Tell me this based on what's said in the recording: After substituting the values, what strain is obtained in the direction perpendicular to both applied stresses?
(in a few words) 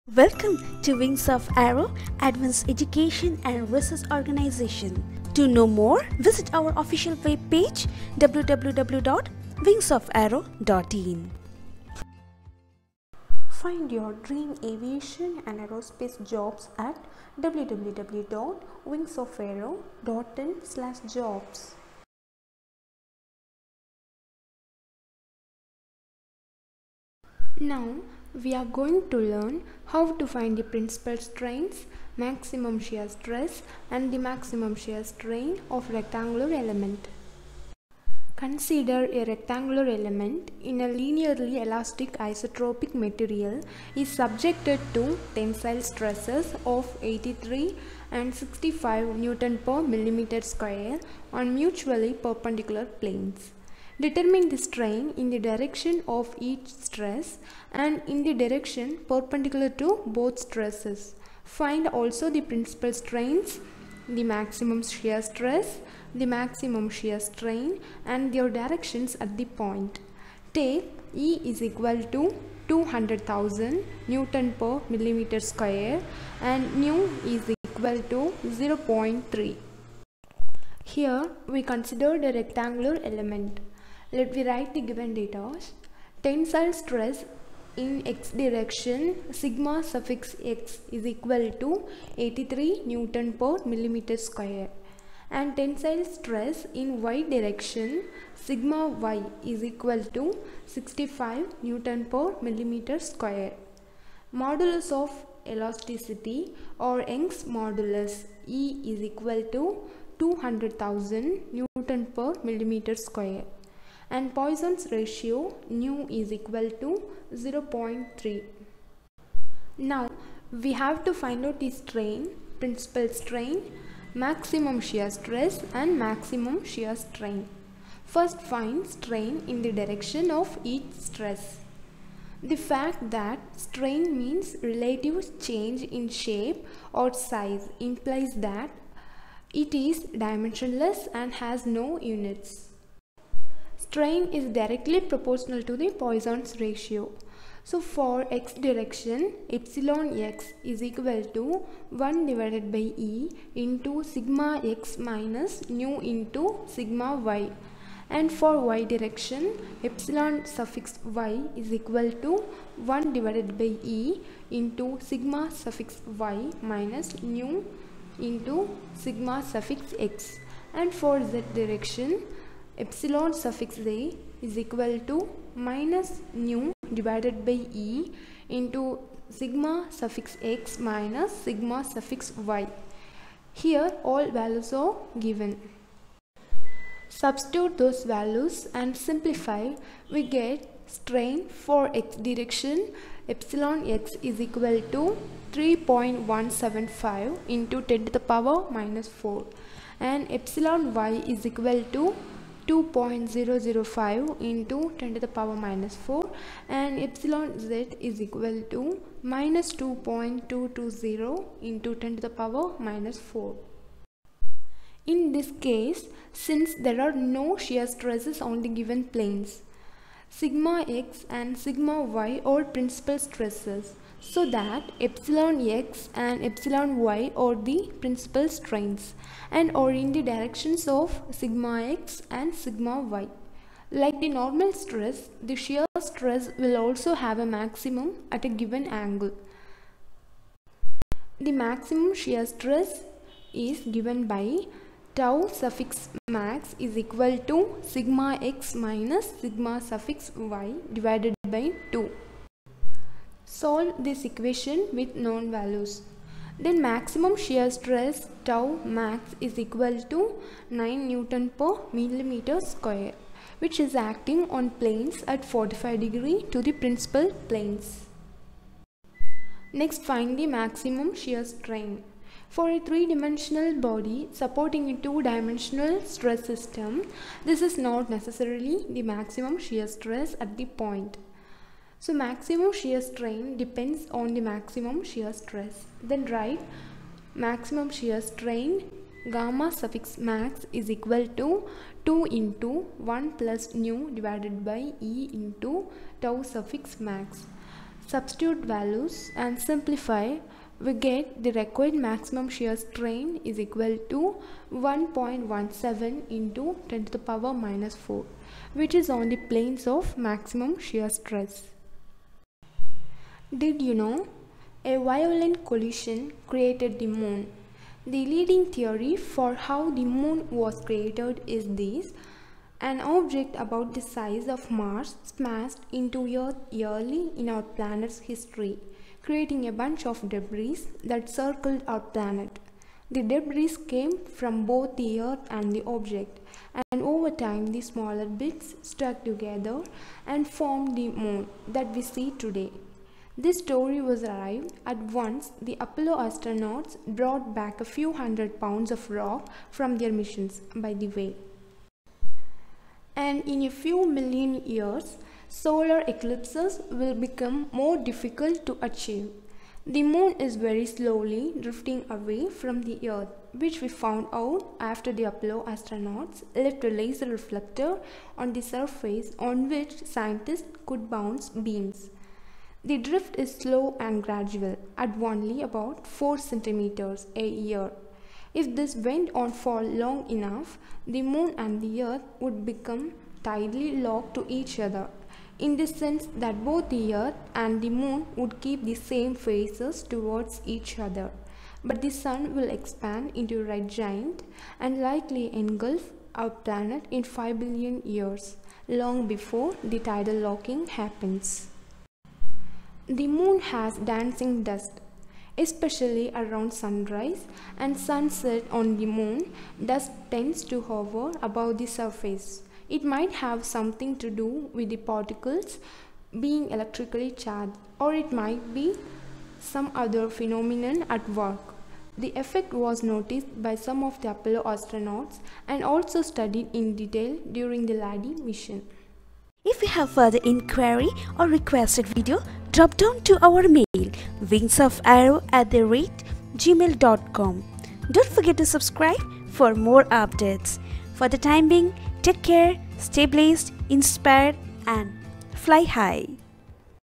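-2.220 x 10^-4.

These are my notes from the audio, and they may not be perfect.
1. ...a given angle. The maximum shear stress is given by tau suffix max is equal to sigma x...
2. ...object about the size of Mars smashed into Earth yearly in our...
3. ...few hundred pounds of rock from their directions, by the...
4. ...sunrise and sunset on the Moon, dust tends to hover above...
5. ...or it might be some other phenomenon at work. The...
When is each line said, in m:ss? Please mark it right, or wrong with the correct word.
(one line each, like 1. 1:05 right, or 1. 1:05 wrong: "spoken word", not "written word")
1. 3:58 right
2. 5:23 right
3. 5:47 wrong: "missions", not "directions"
4. 6:46 right
5. 6:58 right.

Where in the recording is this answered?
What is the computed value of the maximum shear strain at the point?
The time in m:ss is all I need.
5:04.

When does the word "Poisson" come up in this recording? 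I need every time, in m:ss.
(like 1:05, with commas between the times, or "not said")
1:54, 2:26.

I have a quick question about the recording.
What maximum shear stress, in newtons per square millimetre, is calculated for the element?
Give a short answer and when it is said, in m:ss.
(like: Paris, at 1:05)
9, at 4:20.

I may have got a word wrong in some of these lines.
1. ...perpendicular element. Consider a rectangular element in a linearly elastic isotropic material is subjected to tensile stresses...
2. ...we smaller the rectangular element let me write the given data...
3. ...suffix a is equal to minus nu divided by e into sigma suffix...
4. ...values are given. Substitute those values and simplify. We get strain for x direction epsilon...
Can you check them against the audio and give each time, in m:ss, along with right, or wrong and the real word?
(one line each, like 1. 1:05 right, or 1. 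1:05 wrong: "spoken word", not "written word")
1. 0:35 wrong: "rectangular", not "perpendicular"
2. 1:21 wrong: "consider", not "smaller"
3. 2:53 right
4. 3:04 right.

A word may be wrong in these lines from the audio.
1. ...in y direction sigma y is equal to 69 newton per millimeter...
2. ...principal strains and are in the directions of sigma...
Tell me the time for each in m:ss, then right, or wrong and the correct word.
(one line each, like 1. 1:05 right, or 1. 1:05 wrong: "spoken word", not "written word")
1. 1:36 wrong: "65", not "69"
2. 3:48 right.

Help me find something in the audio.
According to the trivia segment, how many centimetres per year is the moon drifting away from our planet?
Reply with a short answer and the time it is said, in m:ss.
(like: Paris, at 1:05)
4, at 6:16.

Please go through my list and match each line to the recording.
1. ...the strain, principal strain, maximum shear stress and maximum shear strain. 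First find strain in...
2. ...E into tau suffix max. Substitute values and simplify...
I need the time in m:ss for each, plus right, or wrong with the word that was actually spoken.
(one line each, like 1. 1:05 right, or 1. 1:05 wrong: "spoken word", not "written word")
1. 2:01 right
2. 4:54 right.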